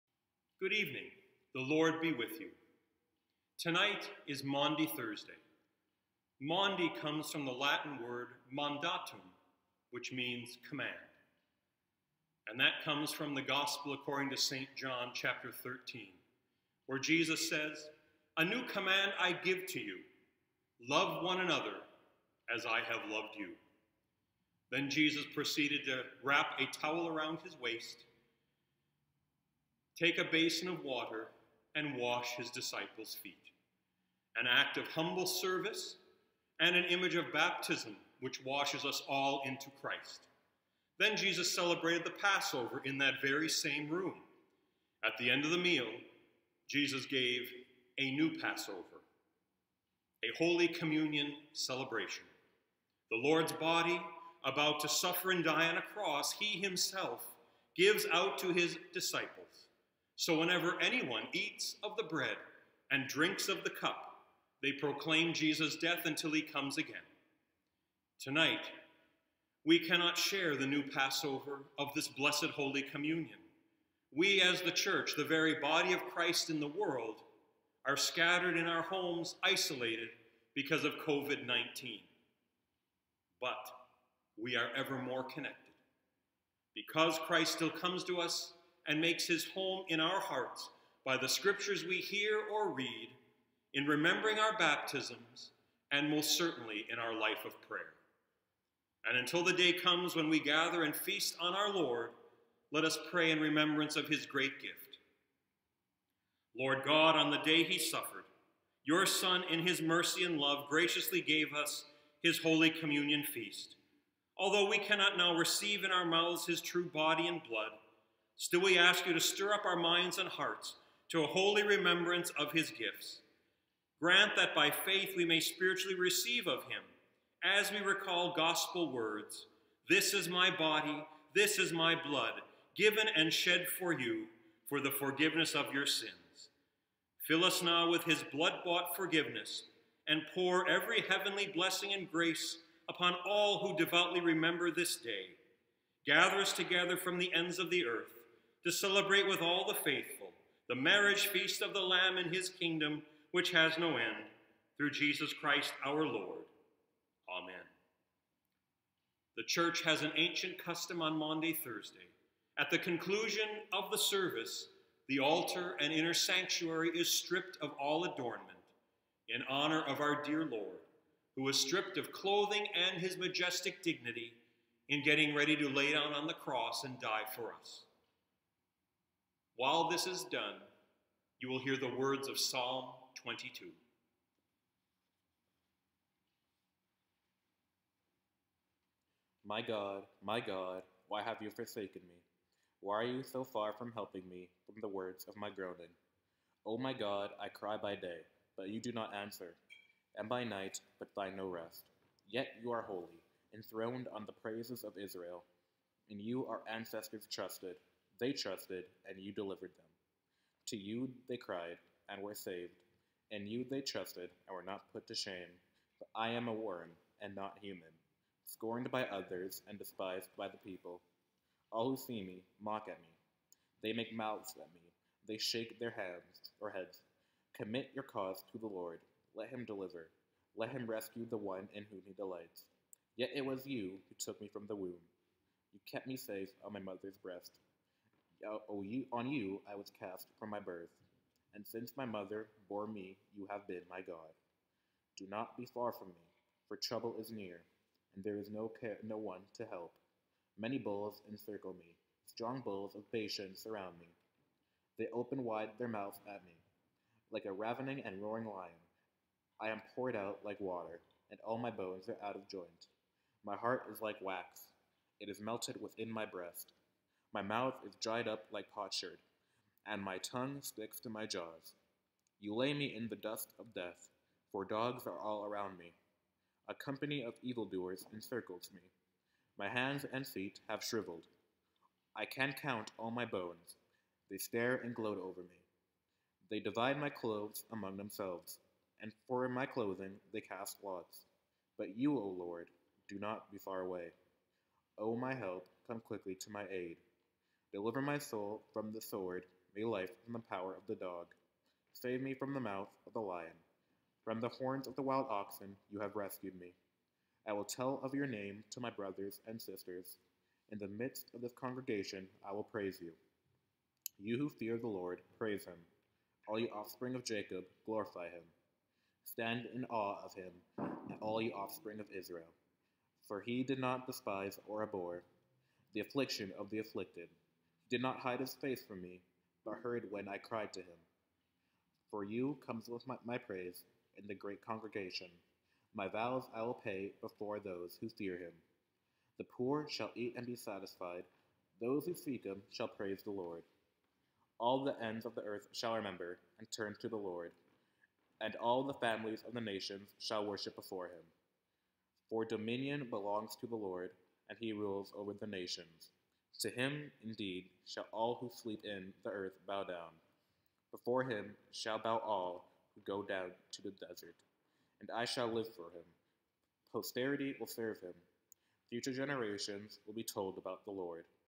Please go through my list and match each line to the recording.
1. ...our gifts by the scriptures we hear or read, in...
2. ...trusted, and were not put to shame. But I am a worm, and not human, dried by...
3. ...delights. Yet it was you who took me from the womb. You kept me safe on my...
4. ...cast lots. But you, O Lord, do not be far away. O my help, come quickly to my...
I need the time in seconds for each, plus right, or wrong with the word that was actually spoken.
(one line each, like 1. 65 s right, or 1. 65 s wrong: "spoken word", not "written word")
1. 89 s wrong: "hearts", not "gifts"
2. 213 s wrong: "scorned", not "dried"
3. 232 s right
4. 290 s right.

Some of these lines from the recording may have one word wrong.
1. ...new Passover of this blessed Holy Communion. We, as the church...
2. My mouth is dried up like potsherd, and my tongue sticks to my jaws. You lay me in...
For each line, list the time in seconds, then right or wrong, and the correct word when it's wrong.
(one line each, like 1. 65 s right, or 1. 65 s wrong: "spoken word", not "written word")
1. 70 s right
2. 267 s right.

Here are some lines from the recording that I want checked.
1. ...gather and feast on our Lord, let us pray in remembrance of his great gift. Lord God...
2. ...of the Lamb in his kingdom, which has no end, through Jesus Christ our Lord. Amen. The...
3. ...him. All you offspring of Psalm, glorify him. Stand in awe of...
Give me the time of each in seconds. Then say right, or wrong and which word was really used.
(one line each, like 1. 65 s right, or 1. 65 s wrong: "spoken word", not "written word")
1. 100 s right
2. 151 s right
3. 315 s wrong: "Jacob", not "Psalm".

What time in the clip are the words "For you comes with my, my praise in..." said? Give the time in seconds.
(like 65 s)
332 s.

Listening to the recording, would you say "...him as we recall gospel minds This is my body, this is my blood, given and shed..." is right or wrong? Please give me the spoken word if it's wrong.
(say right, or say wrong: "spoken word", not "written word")
wrong: "words", not "minds".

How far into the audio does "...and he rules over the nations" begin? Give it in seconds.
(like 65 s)
354 s.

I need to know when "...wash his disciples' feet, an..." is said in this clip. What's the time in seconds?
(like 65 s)
31 s.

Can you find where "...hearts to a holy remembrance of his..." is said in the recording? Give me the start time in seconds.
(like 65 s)
120 s.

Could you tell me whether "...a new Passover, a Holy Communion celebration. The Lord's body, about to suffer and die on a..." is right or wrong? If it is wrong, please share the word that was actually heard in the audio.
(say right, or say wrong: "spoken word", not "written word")
right.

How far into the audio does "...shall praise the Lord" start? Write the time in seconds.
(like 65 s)
342 s.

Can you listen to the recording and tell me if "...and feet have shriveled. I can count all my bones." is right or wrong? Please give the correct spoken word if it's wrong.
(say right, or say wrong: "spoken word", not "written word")
right.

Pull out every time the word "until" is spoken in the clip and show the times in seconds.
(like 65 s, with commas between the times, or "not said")
66 s, 99 s.